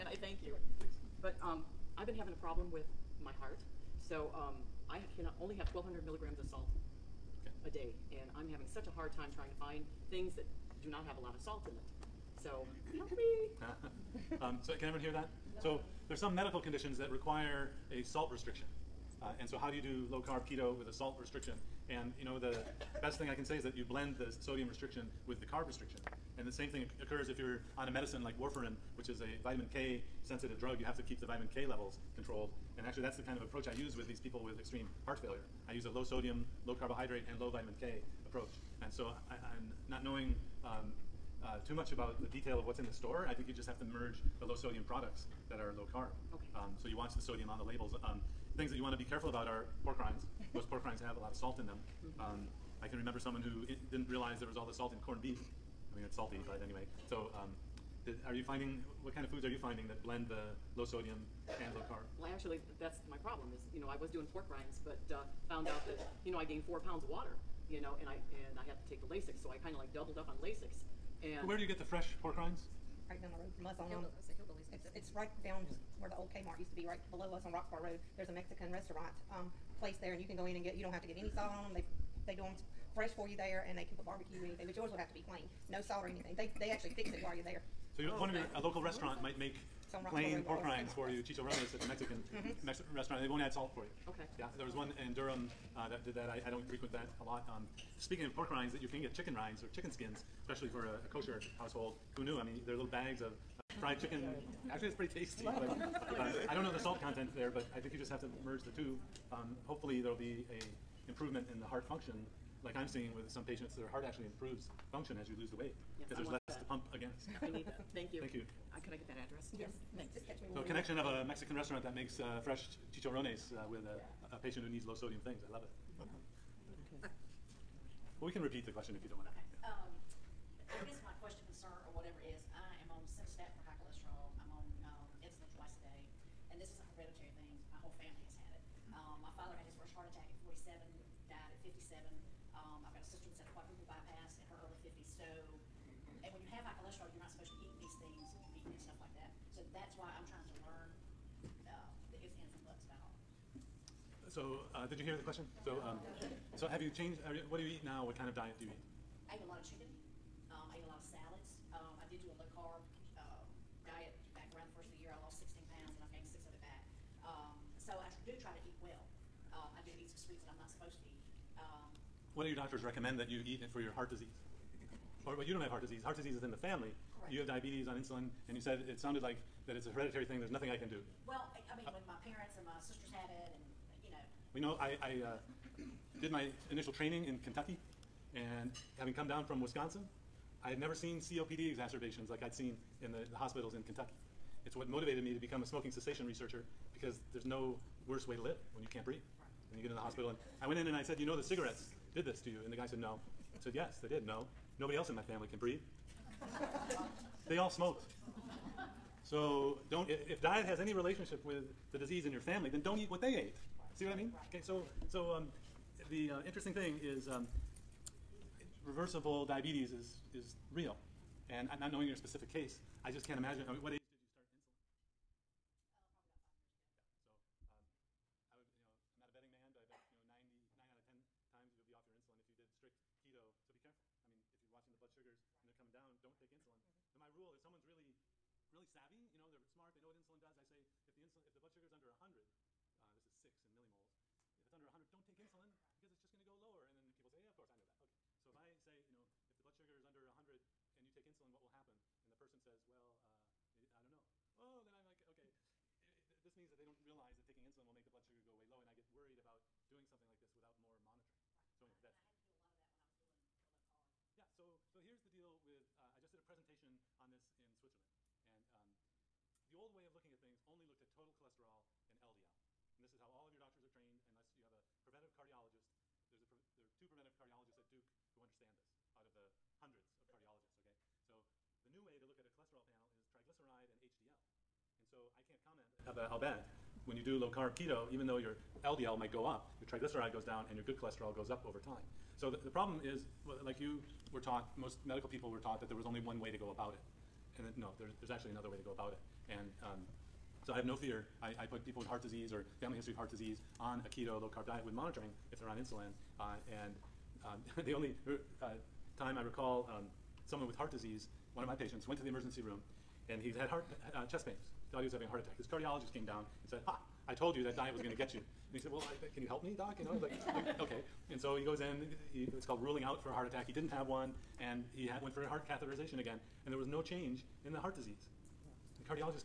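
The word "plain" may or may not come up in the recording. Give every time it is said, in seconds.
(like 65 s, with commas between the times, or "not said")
85 s, 90 s.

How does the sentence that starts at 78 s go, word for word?
There's a Mexican restaurant um, place there, and you can go in and get.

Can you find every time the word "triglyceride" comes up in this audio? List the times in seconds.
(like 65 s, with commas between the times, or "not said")
283 s, 289 s.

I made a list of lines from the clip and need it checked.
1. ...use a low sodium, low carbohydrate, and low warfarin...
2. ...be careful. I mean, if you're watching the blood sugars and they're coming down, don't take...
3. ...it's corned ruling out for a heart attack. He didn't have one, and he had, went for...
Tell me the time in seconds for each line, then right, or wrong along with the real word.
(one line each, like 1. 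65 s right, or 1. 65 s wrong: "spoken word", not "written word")
1. 35 s wrong: "vitamin", not "warfarin"
2. 233 s right
3. 322 s wrong: "called", not "corned".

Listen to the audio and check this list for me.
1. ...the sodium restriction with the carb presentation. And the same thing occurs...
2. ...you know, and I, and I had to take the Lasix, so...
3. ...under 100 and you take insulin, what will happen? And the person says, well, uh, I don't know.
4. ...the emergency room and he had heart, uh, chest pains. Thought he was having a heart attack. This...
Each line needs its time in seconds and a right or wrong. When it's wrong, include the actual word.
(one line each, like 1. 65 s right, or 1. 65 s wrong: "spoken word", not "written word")
1. 24 s wrong: "restriction", not "presentation"
2. 67 s right
3. 250 s right
4. 312 s right.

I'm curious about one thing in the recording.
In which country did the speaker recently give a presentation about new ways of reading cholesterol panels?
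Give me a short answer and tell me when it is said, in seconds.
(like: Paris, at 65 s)
Switzerland, at 267 s.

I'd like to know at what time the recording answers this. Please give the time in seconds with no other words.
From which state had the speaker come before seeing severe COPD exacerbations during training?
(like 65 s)
189 s.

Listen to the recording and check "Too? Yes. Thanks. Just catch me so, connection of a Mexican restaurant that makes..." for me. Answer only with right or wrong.
right.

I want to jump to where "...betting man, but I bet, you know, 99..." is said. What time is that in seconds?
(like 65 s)
229 s.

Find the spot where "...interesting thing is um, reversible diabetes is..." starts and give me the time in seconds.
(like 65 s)
216 s.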